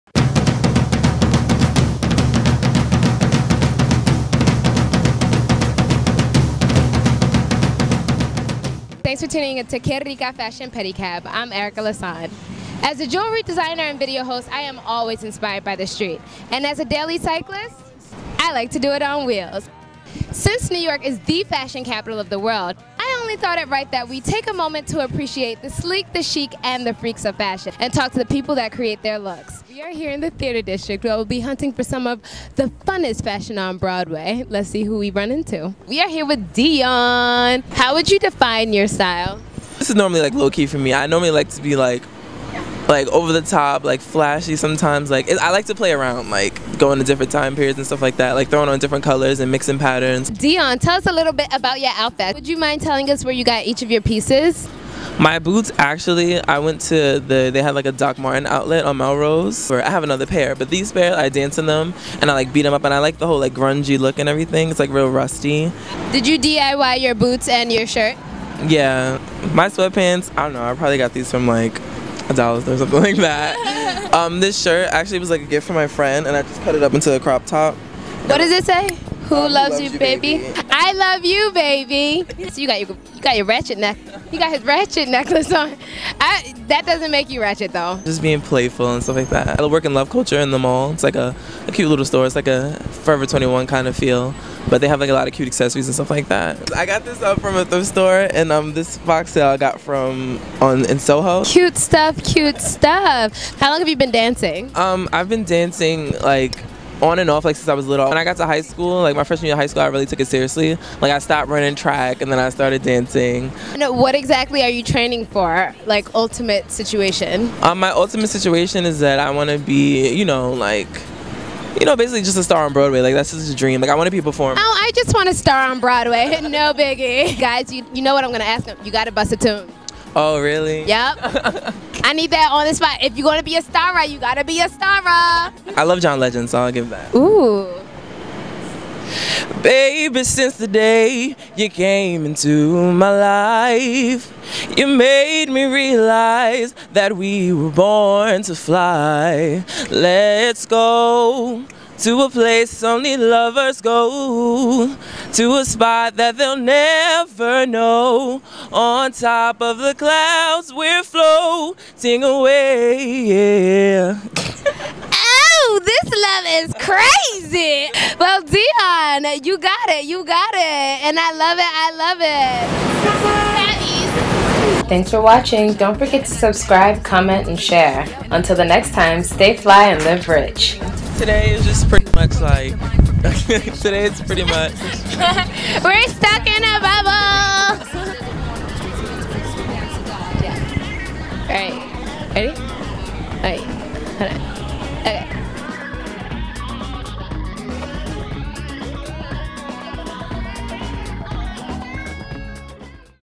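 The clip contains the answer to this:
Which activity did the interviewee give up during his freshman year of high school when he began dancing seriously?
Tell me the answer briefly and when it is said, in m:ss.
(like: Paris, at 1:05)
running track, at 1:51.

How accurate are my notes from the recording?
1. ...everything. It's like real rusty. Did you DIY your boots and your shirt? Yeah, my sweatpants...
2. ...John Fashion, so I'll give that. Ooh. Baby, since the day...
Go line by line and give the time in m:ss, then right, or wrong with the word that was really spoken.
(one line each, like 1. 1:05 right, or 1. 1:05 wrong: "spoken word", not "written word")
1. 1:04 right
2. 2:16 wrong: "Legend", not "Fashion".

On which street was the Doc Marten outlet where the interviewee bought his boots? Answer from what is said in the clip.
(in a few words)
Melrose.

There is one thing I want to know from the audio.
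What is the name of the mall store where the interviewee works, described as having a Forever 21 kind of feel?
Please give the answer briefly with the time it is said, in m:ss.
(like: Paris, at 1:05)
Love Culture, at 1:29.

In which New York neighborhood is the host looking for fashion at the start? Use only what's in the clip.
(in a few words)
Theater District.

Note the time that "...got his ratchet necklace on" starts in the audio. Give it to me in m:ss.
1:24.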